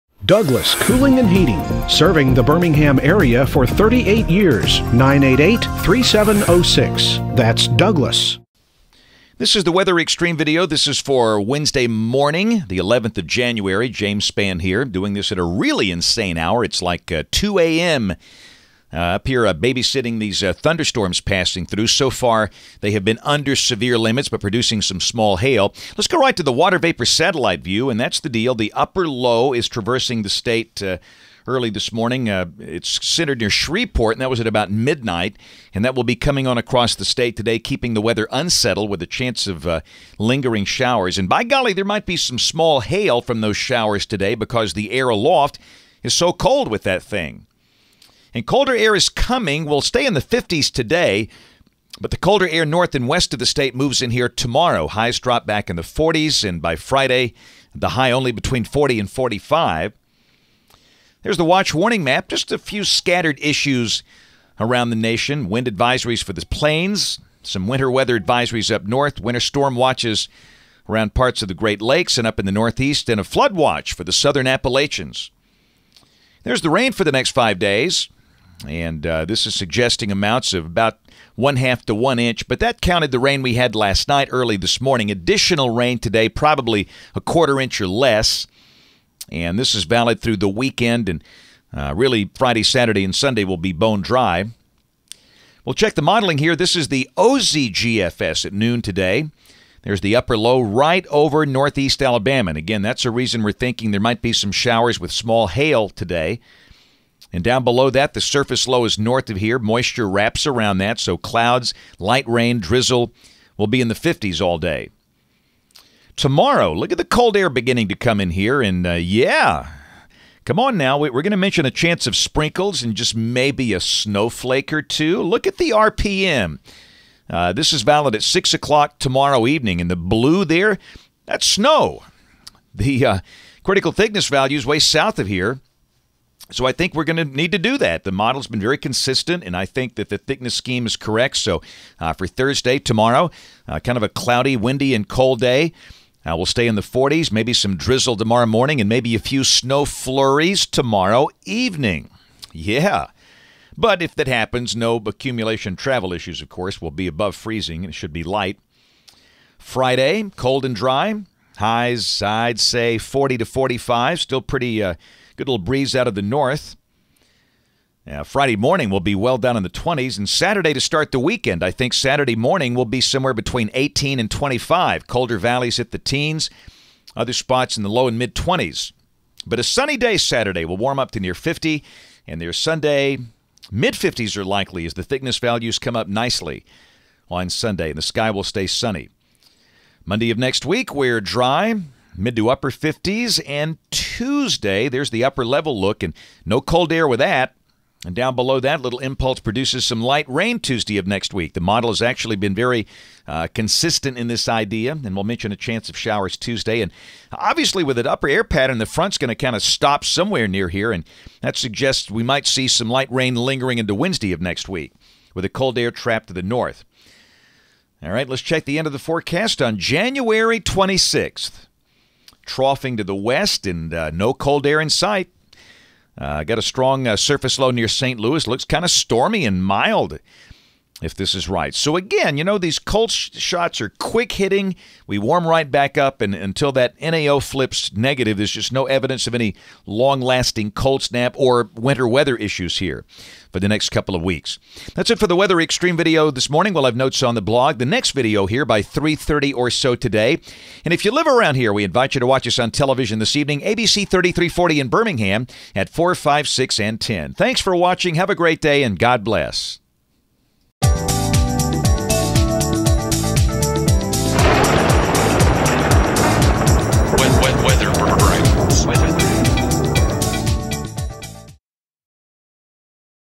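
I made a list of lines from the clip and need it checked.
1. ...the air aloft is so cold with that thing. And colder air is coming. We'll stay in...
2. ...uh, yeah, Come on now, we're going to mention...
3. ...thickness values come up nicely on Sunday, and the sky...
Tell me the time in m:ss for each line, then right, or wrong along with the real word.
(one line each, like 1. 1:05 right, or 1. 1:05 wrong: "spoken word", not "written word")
1. 0:44 right
2. 1:58 right
3. 3:05 right.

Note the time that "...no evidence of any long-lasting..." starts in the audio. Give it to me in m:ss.
3:58.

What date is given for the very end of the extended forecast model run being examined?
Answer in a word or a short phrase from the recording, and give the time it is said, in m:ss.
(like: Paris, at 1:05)
January 26th, at 3:39.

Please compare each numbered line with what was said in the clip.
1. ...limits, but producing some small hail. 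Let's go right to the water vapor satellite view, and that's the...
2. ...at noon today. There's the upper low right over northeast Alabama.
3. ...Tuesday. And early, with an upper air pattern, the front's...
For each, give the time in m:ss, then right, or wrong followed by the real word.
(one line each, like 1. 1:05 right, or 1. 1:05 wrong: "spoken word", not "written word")
1. 0:23 right
2. 1:38 right
3. 3:26 wrong: "obviously", not "early".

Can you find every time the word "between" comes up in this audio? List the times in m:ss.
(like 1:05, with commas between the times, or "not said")
0:58, 2:53.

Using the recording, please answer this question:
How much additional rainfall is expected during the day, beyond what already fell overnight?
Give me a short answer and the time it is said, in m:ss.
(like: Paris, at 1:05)
a quarter inch or less, at 1:27.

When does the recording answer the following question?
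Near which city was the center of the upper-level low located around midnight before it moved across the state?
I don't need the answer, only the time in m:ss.
0:33.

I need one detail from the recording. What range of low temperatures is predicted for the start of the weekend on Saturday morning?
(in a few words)
18 to 25.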